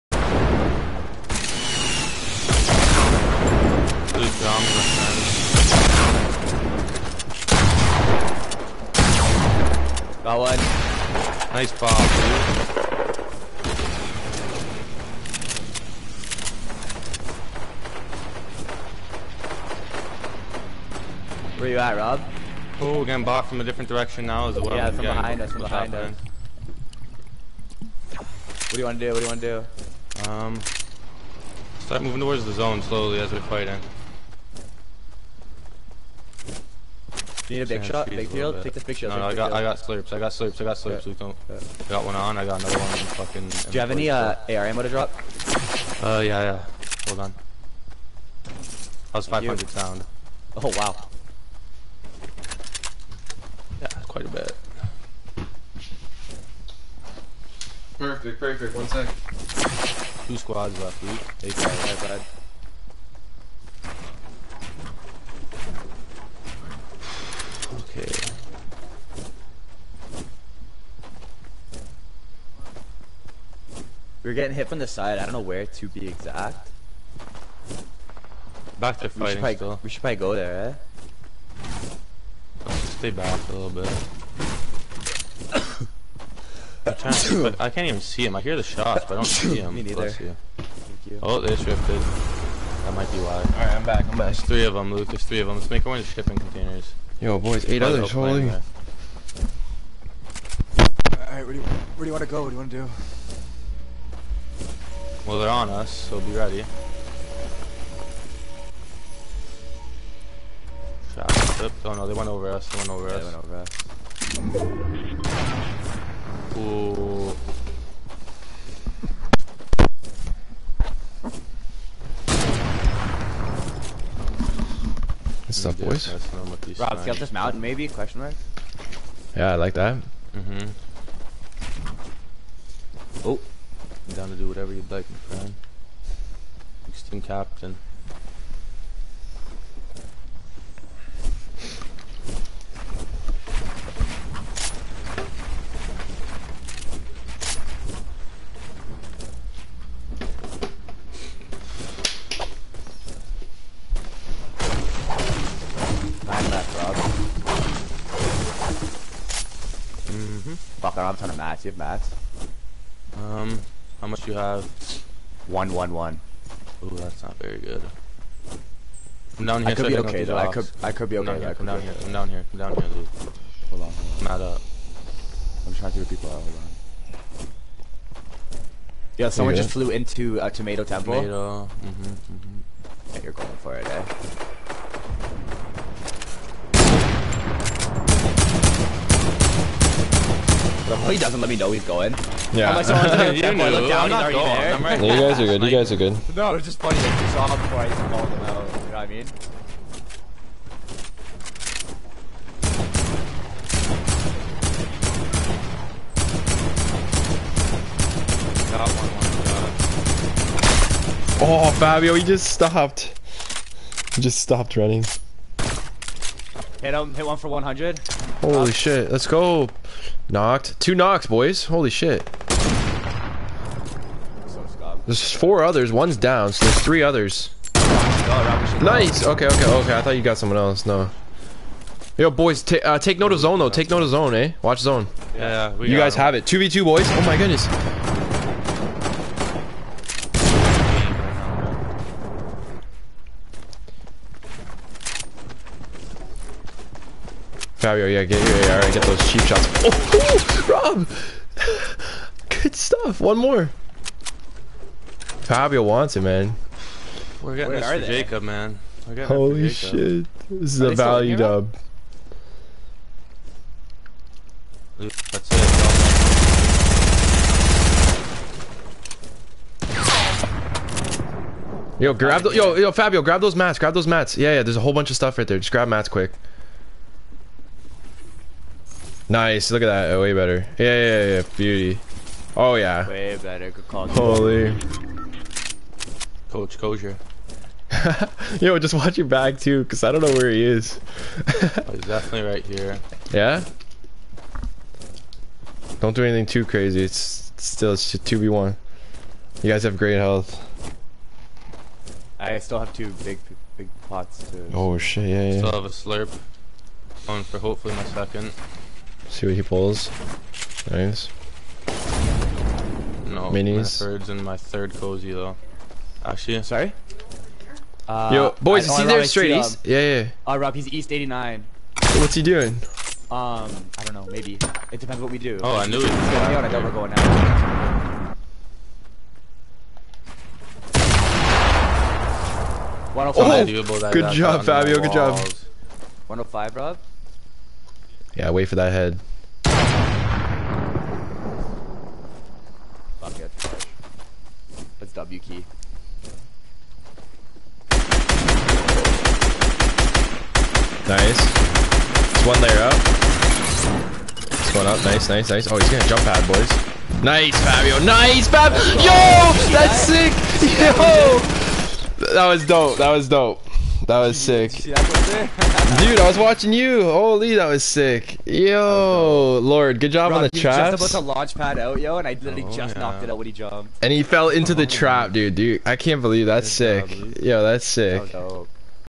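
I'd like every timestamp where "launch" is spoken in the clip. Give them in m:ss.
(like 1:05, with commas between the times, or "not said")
6:11.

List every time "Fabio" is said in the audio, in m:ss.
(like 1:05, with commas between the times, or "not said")
3:31, 4:07, 4:15, 4:32, 5:34, 5:57.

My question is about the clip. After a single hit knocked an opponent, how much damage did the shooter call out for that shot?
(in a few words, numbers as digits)
100.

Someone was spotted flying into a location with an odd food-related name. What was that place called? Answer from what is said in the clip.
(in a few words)
Tomato Temple.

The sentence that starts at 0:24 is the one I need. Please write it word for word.
Yeah, from behind us, from behind us.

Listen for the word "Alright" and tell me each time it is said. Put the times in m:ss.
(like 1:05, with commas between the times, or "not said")
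1:33, 1:38.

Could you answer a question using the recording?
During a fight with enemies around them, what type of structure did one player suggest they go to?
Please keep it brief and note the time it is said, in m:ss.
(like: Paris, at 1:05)
Shipping containers, at 1:36.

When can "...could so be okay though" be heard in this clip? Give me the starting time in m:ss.
2:49.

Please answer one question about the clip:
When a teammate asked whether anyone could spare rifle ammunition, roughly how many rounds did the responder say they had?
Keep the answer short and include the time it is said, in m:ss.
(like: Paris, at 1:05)
500, at 0:49.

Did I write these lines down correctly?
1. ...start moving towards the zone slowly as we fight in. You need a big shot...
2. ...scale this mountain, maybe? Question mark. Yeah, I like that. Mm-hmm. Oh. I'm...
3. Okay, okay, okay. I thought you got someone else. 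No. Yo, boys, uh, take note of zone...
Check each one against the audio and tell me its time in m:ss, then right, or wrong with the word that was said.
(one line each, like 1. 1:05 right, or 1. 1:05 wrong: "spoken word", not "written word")
1. 0:31 right
2. 2:07 right
3. 3:49 right.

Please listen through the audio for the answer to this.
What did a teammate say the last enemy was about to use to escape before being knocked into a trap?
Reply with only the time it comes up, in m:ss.
5:56.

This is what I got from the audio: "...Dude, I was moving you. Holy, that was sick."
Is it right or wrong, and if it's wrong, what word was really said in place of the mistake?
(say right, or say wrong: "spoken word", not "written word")
wrong: "watching", not "moving".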